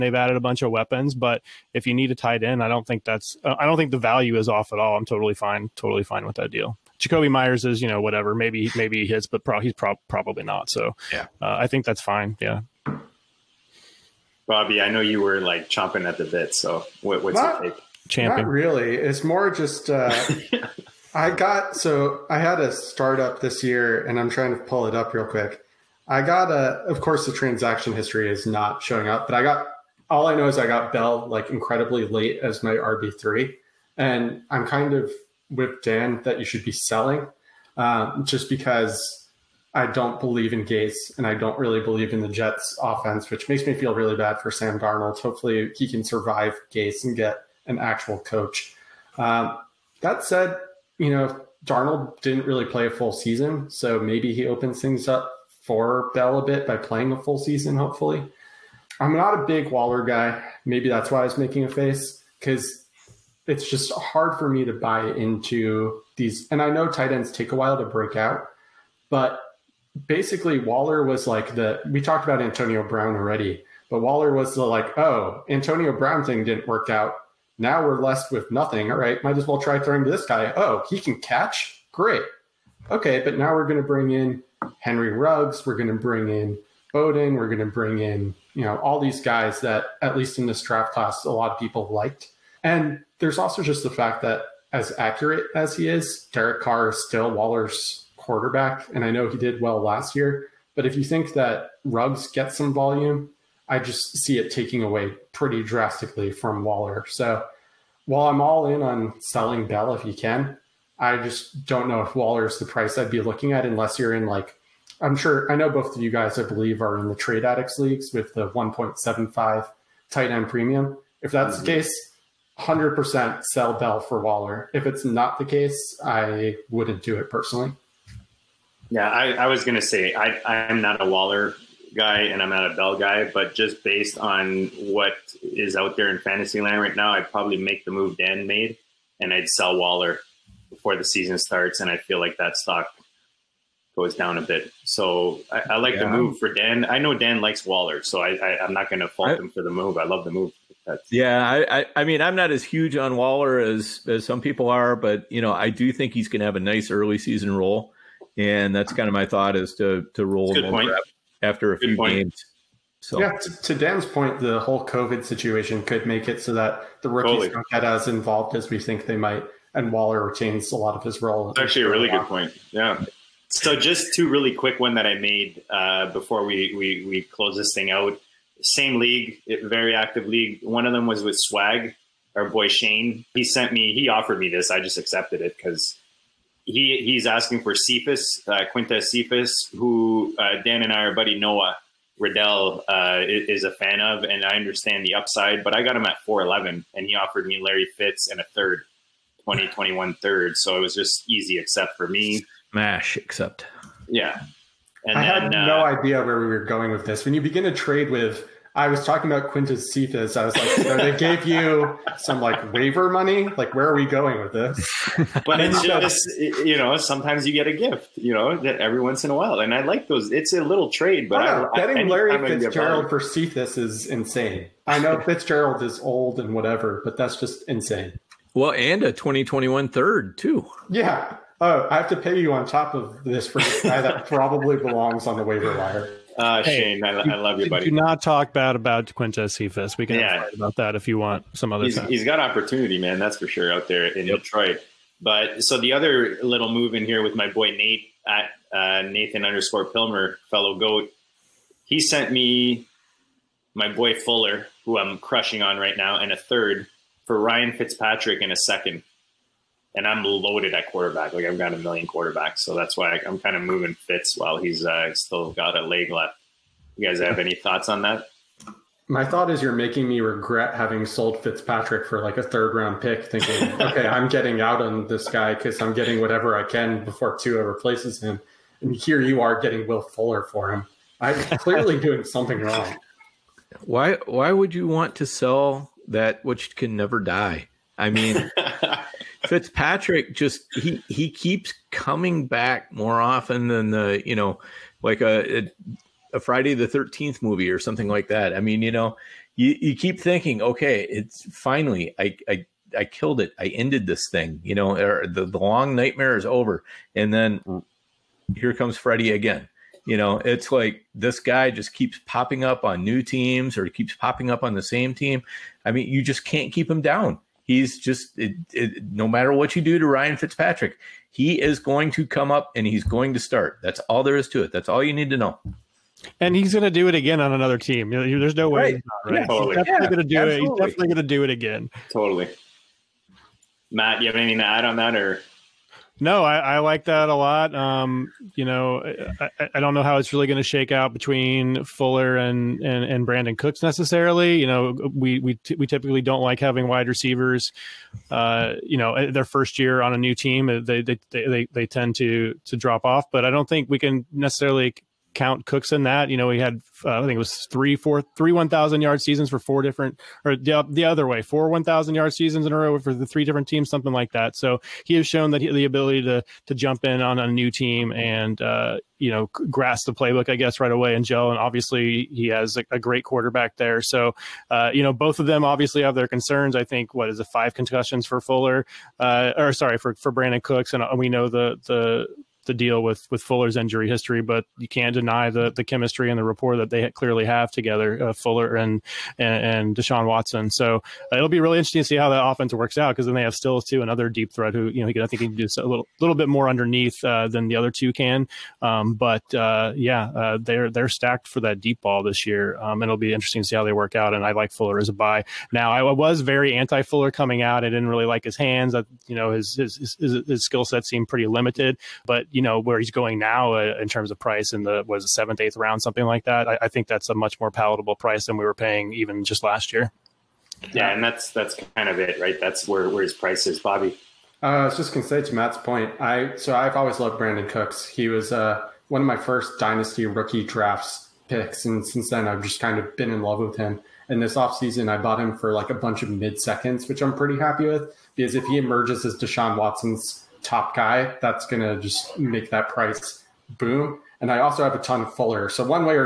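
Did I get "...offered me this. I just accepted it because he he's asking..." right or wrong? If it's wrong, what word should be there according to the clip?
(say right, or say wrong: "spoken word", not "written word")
right.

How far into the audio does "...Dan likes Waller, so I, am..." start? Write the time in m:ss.
2:27.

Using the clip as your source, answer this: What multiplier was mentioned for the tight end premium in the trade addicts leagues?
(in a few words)
1.75.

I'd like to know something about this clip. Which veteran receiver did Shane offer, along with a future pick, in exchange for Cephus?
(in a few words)
Larry Fitzgerald.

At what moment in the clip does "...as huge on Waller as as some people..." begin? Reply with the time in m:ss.
2:32.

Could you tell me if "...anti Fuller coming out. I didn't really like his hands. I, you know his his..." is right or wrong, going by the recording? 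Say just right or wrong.
right.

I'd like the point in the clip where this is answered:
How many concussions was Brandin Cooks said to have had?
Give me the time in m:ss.
6:17.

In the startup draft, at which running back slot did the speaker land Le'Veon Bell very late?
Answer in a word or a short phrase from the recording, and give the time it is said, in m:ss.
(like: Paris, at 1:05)
RB3, at 0:32.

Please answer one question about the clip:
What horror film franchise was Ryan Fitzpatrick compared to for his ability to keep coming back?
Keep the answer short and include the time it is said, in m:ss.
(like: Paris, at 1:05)
Friday the Thirteenth, at 4:56.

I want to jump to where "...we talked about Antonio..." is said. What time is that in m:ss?
1:11.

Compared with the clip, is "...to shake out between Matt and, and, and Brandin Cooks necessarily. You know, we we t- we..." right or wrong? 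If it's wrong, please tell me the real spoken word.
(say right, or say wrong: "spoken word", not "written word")
wrong: "Fuller", not "Matt".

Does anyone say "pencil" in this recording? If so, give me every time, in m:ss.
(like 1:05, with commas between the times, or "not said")
not said.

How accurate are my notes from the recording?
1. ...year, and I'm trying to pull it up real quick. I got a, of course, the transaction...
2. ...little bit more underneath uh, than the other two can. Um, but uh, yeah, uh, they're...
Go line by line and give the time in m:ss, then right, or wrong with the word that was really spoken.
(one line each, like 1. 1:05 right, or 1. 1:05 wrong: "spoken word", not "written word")
1. 0:23 right
2. 6:36 right.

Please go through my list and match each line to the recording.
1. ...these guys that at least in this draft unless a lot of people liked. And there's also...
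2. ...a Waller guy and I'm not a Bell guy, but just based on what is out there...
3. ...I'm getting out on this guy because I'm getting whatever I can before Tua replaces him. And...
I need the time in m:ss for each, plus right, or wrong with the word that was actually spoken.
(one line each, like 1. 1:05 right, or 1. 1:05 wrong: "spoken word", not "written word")
1. 1:28 wrong: "class", not "unless"
2. 2:11 right
3. 4:34 right.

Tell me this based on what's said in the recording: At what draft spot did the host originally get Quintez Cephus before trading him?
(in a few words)
4.11.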